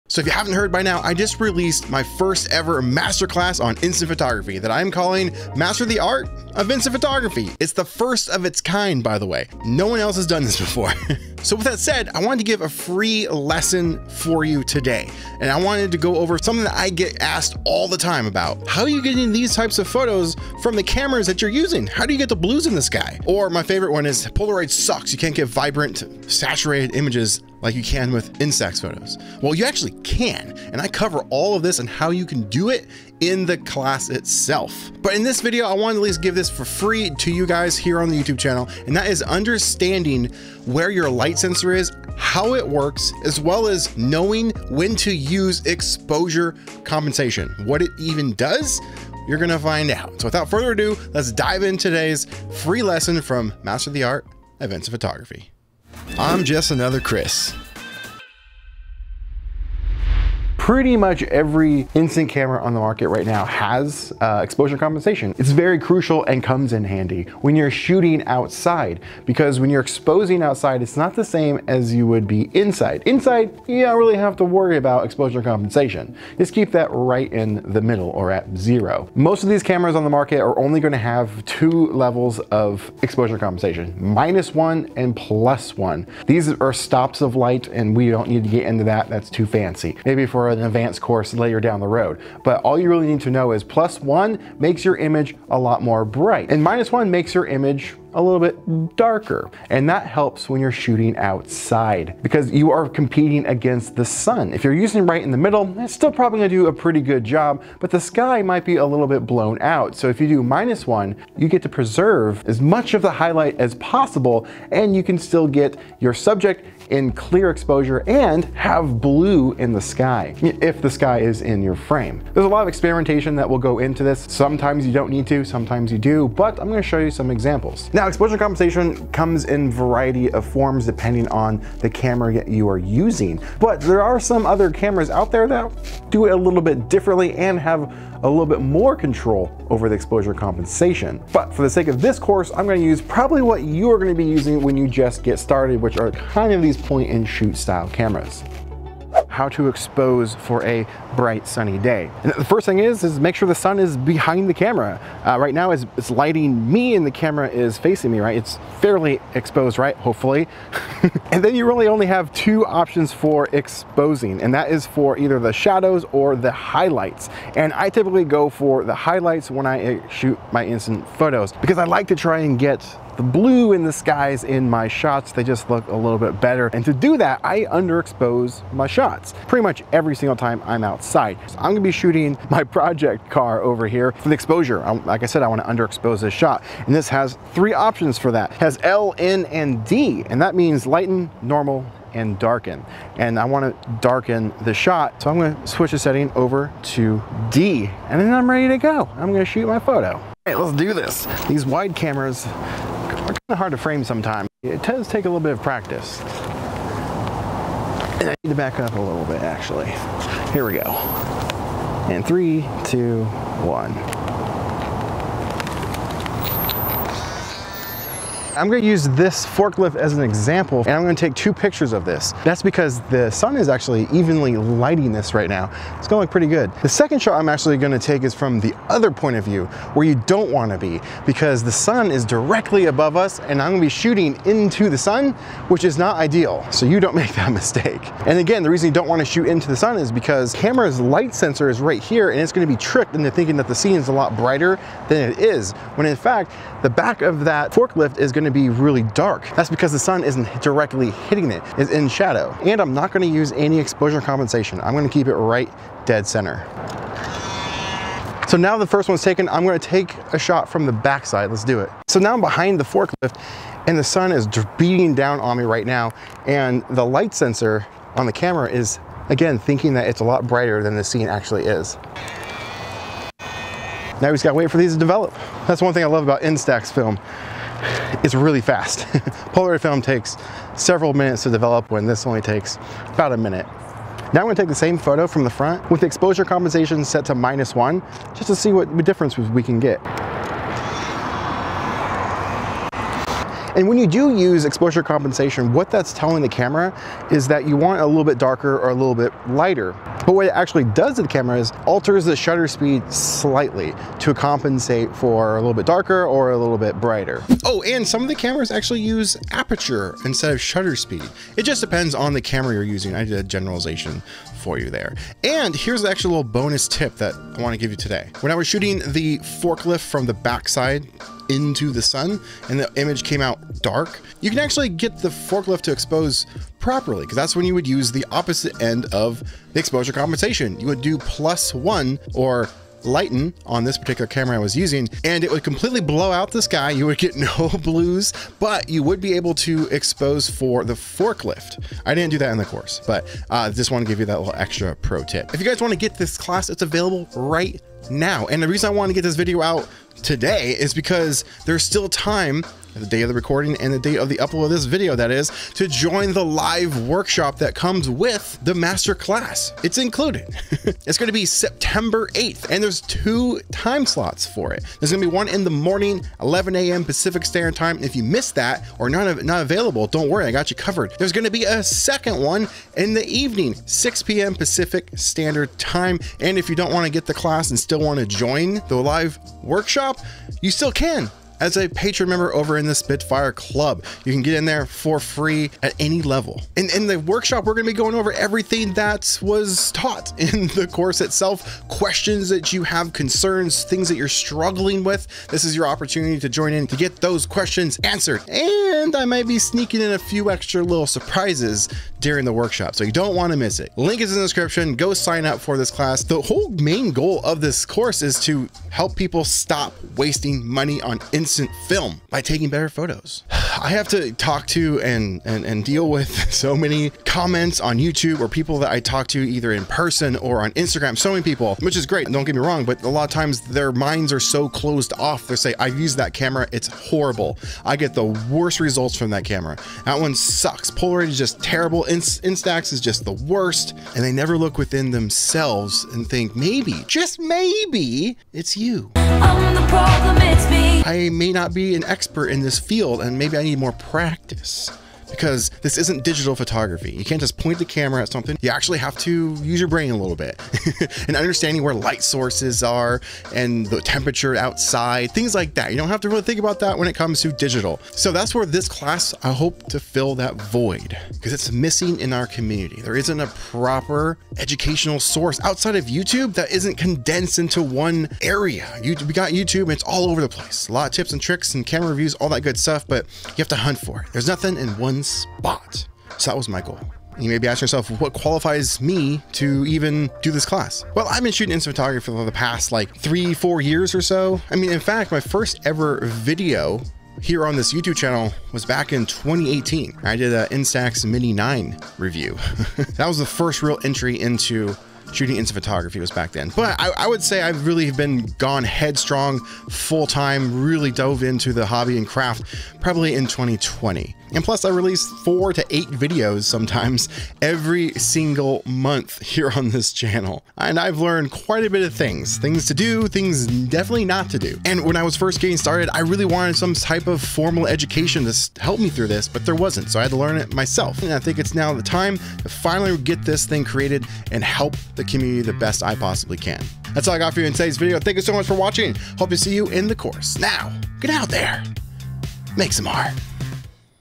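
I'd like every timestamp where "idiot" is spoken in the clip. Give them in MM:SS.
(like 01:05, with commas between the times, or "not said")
not said.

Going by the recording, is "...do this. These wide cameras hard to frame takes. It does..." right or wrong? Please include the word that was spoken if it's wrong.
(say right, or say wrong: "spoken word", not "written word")
wrong: "sometimes", not "takes".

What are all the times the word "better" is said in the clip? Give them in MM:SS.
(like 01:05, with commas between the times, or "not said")
02:56, 06:52.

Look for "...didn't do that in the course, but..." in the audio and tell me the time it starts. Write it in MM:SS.
05:42.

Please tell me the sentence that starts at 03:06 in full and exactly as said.
And this has three options for that.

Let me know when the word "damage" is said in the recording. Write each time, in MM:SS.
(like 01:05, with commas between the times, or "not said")
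not said.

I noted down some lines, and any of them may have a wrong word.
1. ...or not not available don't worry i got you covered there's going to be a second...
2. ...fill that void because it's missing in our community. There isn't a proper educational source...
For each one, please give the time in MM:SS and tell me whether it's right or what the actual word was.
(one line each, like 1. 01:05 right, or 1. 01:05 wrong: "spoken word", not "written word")
1. 06:08 right
2. 07:39 right.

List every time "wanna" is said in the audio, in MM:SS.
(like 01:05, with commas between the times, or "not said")
03:05, 03:13, 03:50, 03:59.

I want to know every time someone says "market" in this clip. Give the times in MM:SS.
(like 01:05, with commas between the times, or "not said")
01:02, 01:20.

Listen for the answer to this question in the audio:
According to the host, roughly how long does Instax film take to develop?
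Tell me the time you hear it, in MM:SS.
04:43.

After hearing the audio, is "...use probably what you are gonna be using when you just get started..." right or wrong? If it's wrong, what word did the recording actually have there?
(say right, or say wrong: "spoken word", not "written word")
right.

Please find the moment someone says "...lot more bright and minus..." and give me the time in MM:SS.
01:35.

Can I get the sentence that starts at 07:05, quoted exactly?
They say, I've used that camera, it's horrible.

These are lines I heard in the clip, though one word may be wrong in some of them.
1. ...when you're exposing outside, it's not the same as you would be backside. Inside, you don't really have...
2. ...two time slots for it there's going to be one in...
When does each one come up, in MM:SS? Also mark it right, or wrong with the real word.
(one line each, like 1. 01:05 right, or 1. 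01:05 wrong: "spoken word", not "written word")
1. 01:09 wrong: "inside", not "backside"
2. 06:02 right.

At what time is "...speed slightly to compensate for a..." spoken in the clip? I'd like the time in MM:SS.
05:02.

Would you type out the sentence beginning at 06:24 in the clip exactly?
You can get in there for free at any level.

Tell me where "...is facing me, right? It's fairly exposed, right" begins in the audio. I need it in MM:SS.
02:37.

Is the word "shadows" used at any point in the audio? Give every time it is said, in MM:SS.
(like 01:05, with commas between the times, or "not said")
02:45, 04:12.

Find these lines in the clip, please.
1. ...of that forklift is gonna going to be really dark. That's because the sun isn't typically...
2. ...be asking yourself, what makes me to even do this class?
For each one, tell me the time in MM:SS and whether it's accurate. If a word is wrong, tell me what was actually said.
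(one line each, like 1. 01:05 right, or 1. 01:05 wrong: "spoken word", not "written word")
1. 04:07 wrong: "directly", not "typically"
2. 07:57 wrong: "qualifies", not "makes".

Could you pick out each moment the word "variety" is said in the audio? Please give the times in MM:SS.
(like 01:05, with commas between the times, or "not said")
02:09.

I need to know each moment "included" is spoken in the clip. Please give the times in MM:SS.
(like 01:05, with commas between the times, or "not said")
05:59.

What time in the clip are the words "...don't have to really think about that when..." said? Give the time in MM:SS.
07:35.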